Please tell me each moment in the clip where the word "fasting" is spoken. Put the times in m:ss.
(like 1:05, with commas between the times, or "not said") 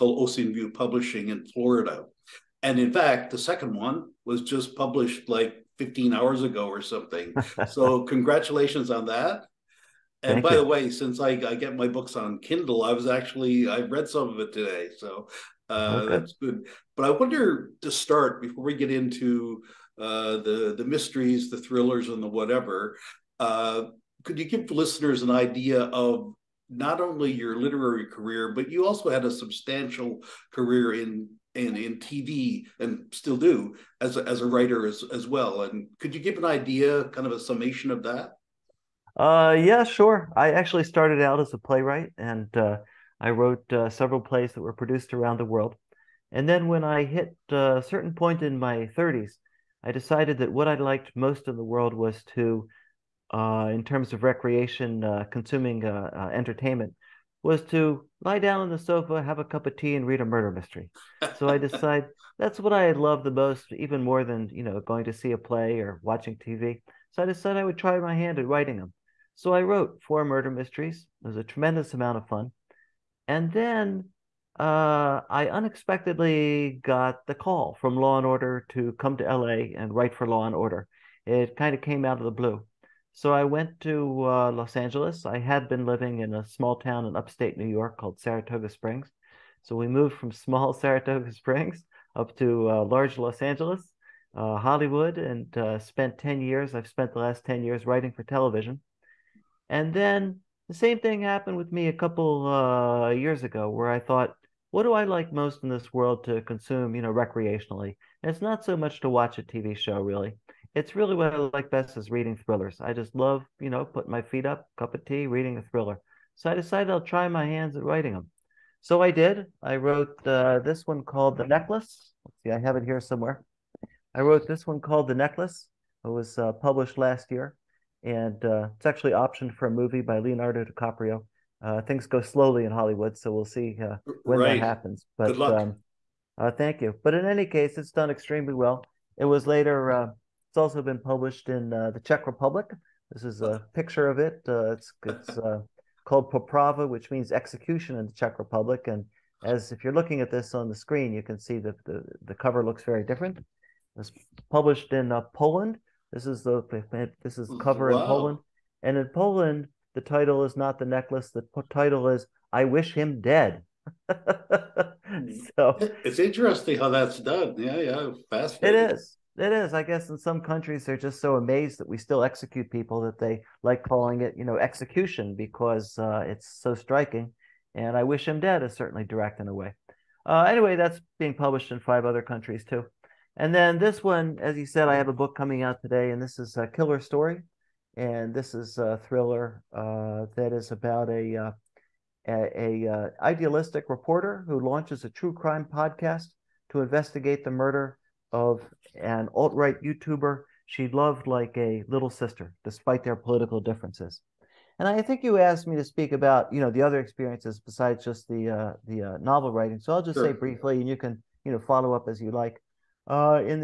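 not said.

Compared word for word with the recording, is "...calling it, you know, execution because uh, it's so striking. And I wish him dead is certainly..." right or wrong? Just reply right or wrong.
right.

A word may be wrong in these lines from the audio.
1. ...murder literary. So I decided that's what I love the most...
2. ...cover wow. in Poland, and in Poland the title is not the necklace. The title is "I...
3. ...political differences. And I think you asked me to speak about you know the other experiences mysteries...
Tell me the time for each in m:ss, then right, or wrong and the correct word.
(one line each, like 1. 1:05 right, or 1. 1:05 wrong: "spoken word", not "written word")
1. 1:00 wrong: "mystery", not "literary"
2. 2:37 right
3. 3:23 wrong: "besides", not "mysteries".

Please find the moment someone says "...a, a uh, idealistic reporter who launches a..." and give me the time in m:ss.
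3:12.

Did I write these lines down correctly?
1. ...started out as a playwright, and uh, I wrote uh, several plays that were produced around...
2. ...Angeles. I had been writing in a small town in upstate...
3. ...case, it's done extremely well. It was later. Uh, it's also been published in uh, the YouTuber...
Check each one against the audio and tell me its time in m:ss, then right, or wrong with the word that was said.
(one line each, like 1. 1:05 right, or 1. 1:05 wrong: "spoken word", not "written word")
1. 0:40 right
2. 1:24 wrong: "living", not "writing"
3. 2:17 wrong: "Czech", not "YouTuber".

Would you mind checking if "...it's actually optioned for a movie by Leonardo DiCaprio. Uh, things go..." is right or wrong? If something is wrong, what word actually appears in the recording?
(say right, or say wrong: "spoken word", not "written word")
right.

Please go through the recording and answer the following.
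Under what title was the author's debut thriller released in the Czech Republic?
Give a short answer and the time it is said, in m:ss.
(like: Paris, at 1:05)
Poprava, at 2:26.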